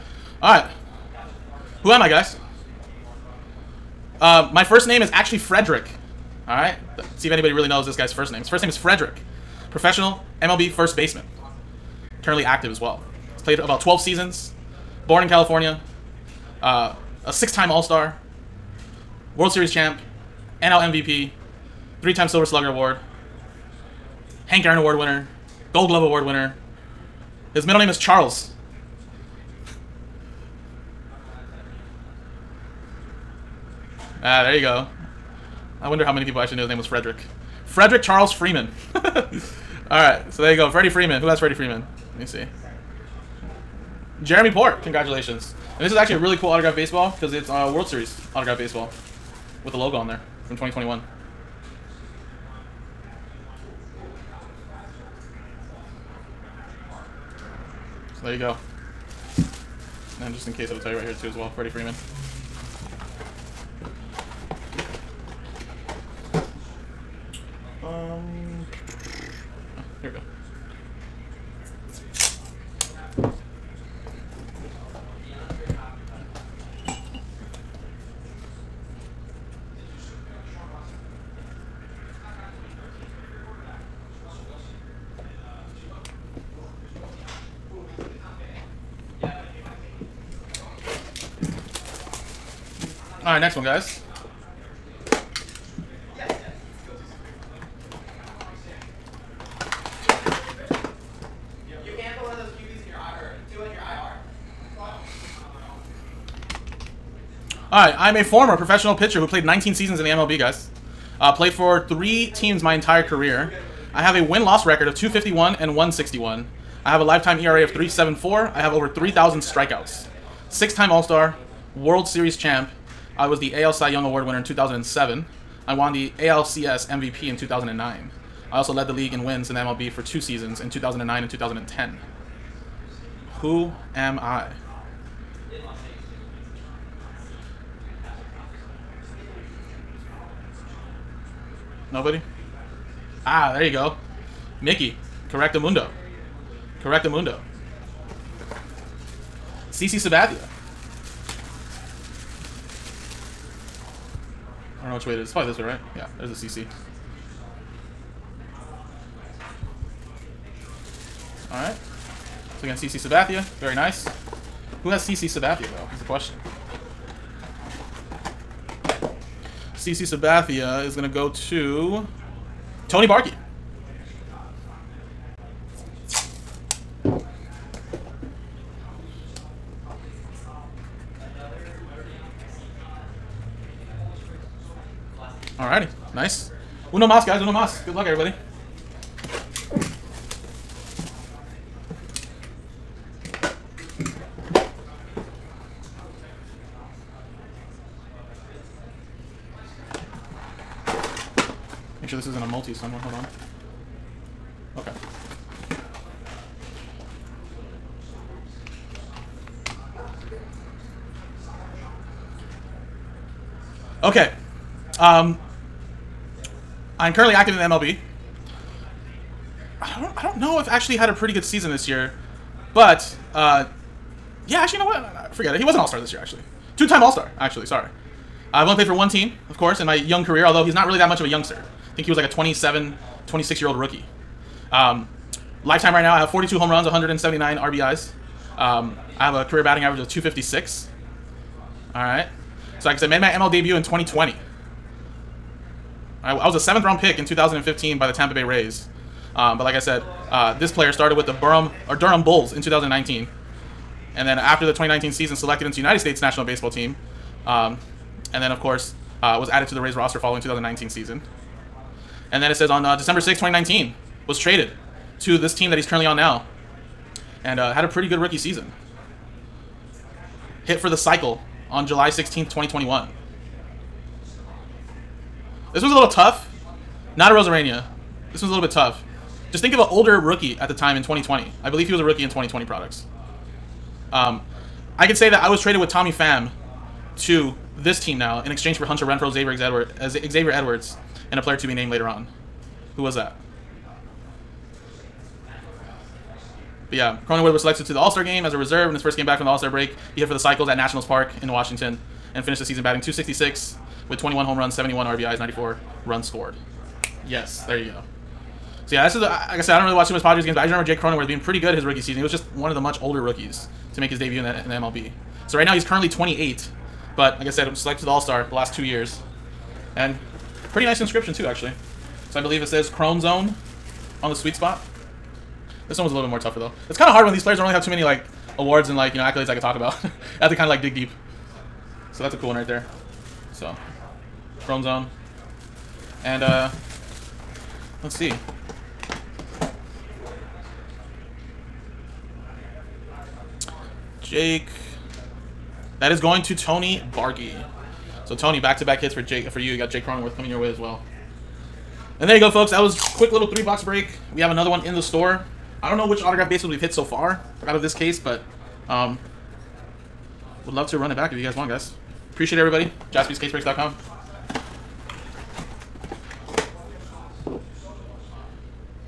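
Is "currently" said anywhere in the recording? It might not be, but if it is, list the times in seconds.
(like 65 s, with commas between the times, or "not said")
12 s, 217 s, 265 s, 315 s.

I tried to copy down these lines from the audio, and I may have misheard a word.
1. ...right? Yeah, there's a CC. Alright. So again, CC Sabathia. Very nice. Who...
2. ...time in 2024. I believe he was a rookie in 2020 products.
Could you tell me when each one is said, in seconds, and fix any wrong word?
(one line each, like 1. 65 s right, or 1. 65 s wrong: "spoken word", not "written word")
1. 155 s right
2. 280 s wrong: "2020", not "2024".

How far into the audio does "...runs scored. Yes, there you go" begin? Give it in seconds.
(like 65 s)
306 s.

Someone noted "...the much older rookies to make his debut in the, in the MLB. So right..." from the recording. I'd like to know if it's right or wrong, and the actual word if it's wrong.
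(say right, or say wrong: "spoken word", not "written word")
right.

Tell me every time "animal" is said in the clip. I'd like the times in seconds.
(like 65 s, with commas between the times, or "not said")
not said.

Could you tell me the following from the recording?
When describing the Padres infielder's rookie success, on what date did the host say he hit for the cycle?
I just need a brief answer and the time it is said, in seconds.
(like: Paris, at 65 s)
July 16th, 2021, at 271 s.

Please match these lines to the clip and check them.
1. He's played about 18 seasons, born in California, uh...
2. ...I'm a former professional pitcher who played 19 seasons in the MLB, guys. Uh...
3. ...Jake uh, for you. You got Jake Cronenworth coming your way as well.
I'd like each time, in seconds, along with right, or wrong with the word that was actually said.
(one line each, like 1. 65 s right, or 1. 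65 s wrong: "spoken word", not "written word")
1. 13 s wrong: "12", not "18"
2. 107 s right
3. 349 s right.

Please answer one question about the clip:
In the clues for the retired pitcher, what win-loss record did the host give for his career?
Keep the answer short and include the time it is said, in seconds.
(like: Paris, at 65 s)
251 and 161, at 114 s.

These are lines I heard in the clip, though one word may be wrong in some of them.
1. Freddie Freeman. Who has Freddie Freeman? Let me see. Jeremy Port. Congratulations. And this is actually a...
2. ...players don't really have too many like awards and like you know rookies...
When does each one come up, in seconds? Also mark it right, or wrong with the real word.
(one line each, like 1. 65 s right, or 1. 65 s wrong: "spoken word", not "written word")
1. 40 s right
2. 327 s wrong: "accolades", not "rookies".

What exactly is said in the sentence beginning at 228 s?
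I've only played for one team, of course, in my young career, although he's not really that much of a youngster.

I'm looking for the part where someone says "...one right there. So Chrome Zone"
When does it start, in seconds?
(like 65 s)
332 s.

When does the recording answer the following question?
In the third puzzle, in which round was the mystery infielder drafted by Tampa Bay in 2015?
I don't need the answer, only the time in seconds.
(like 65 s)
246 s.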